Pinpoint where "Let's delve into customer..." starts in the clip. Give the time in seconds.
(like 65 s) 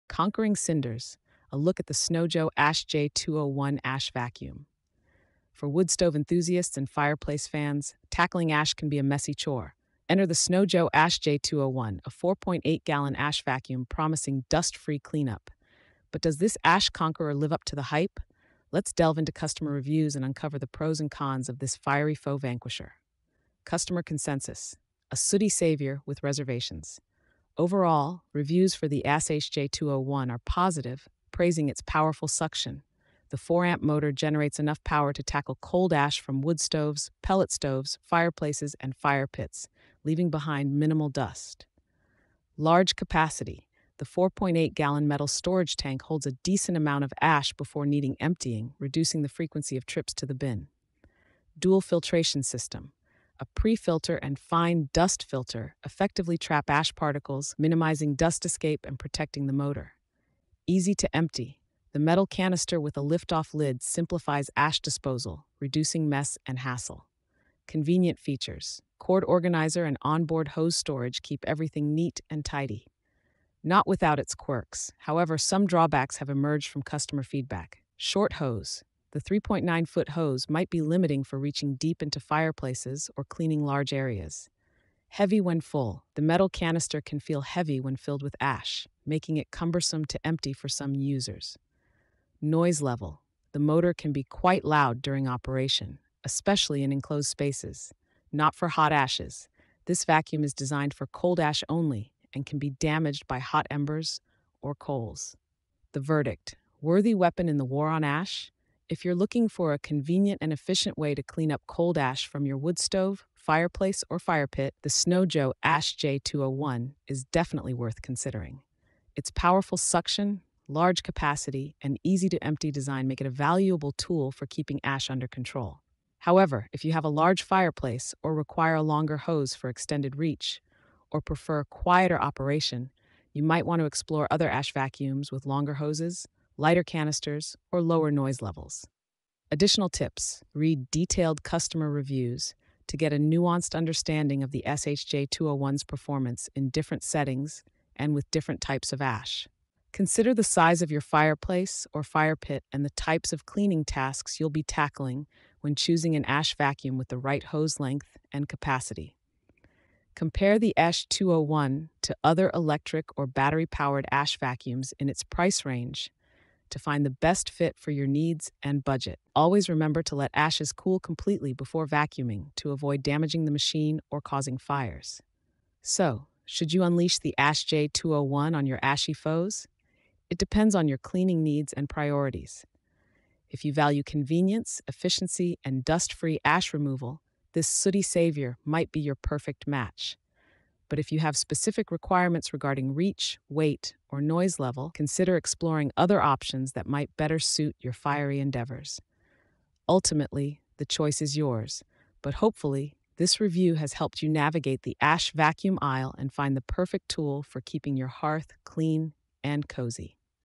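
18 s.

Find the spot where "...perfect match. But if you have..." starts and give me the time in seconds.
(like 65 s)
189 s.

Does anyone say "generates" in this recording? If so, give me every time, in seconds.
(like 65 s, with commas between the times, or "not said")
34 s.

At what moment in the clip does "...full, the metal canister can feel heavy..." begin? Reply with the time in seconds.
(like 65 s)
85 s.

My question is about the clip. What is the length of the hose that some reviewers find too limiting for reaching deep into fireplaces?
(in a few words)
3.9 foot.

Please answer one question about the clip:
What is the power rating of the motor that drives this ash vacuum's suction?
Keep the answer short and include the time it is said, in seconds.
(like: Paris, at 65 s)
4 amp, at 33 s.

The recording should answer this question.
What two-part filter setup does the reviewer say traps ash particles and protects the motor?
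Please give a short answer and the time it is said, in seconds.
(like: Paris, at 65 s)
Dual filtration system, at 51 s.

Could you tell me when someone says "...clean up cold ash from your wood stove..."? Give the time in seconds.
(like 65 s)
111 s.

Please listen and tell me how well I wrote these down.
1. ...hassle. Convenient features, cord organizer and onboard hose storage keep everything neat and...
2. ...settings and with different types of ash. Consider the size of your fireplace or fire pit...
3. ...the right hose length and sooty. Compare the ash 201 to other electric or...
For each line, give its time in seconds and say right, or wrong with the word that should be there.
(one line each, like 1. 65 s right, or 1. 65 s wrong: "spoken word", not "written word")
1. 66 s right
2. 147 s right
3. 157 s wrong: "capacity", not "sooty".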